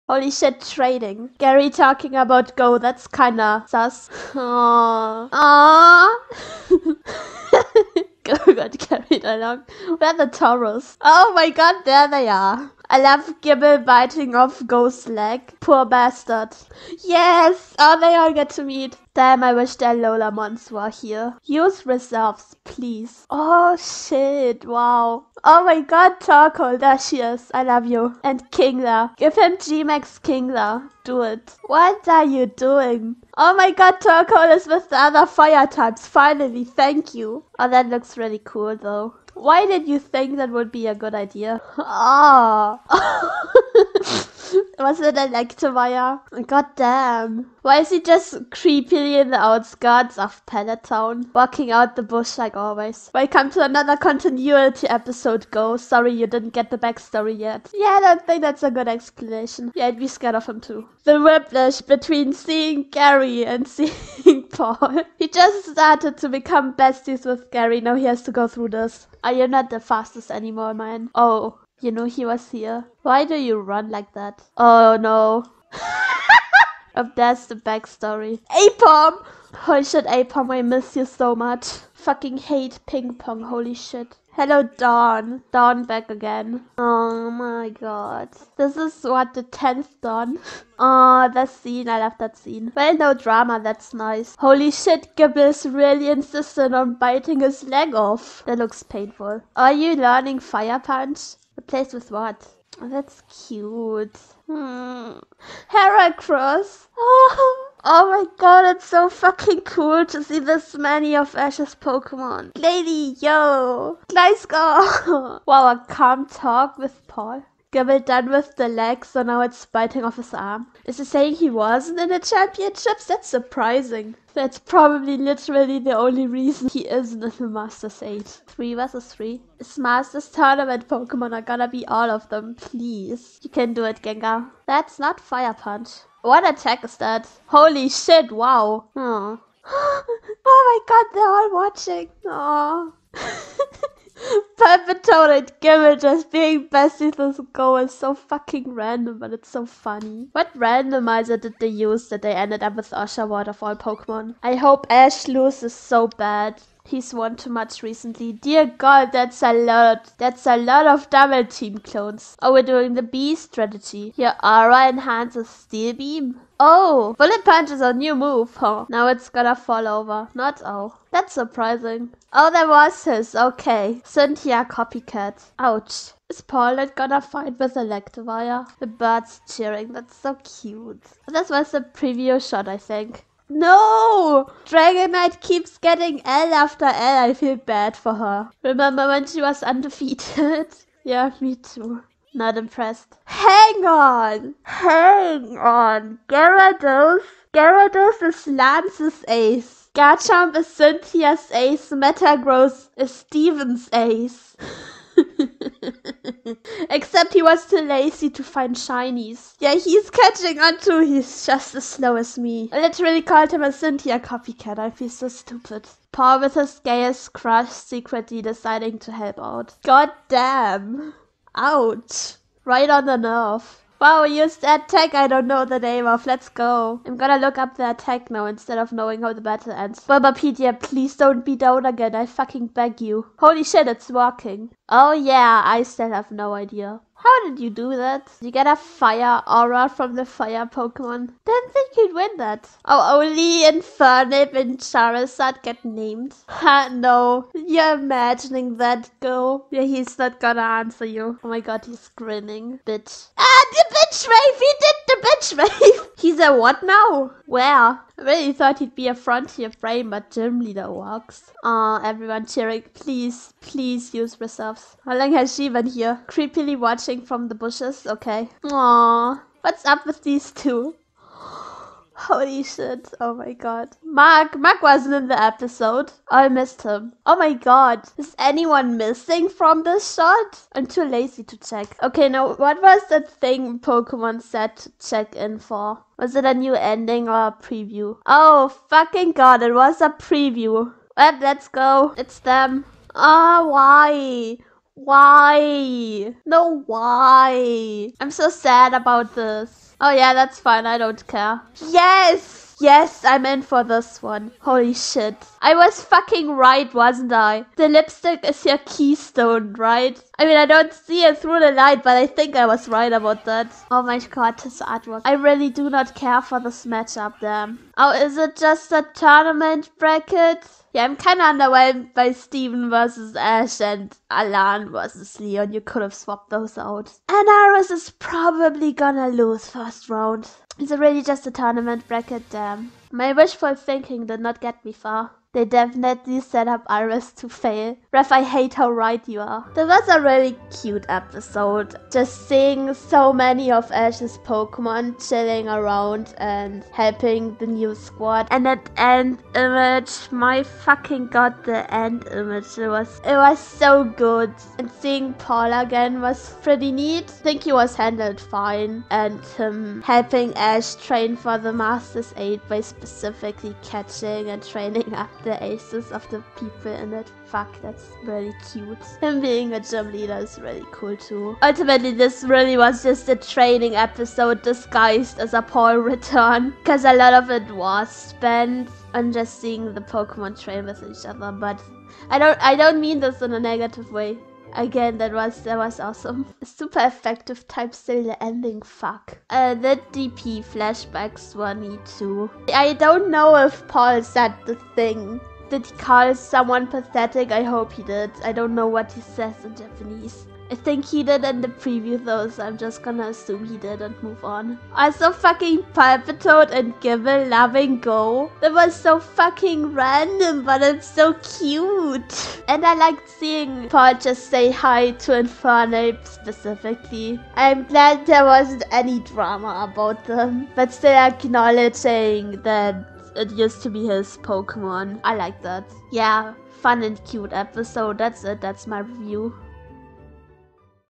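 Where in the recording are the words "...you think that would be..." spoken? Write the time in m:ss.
0:39.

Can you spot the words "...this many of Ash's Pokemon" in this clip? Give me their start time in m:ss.
1:50.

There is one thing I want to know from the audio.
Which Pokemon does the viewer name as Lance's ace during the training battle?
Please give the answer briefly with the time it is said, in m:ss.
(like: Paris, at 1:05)
Gyarados, at 3:17.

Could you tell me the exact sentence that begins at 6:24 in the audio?
Again, that was that was awesome.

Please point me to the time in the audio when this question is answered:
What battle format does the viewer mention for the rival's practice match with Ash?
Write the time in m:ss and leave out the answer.
2:08.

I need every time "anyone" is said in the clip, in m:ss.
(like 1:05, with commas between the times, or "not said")
4:38.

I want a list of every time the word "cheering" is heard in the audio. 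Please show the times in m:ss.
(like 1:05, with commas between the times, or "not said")
2:59, 4:22.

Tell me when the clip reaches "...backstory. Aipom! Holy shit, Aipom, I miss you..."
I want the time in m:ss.
1:17.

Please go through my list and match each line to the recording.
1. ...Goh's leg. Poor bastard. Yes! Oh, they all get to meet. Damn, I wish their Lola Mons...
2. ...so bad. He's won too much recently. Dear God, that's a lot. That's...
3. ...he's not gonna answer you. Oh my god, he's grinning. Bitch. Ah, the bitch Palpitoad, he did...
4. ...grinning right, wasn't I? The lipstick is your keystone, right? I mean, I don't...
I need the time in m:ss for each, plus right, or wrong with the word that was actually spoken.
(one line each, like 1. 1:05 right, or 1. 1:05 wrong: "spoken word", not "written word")
1. 0:14 right
2. 2:35 right
3. 4:09 wrong: "Rafe", not "Palpitoad"
4. 5:06 wrong: "fucking", not "grinning".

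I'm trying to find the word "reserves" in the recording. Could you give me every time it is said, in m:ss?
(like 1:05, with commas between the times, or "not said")
0:21, 4:24.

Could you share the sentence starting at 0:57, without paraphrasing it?
Yeah, I don't think that's a good explanation.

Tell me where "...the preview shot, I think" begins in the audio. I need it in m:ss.
3:01.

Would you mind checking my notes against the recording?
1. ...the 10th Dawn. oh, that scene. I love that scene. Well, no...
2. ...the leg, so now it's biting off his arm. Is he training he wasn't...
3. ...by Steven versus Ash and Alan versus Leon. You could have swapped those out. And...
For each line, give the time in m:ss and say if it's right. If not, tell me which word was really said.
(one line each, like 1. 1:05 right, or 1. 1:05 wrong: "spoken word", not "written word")
1. 1:29 right
2. 1:58 wrong: "saying", not "training"
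3. 5:22 right.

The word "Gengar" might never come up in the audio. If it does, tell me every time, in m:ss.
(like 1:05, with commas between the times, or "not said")
2:14.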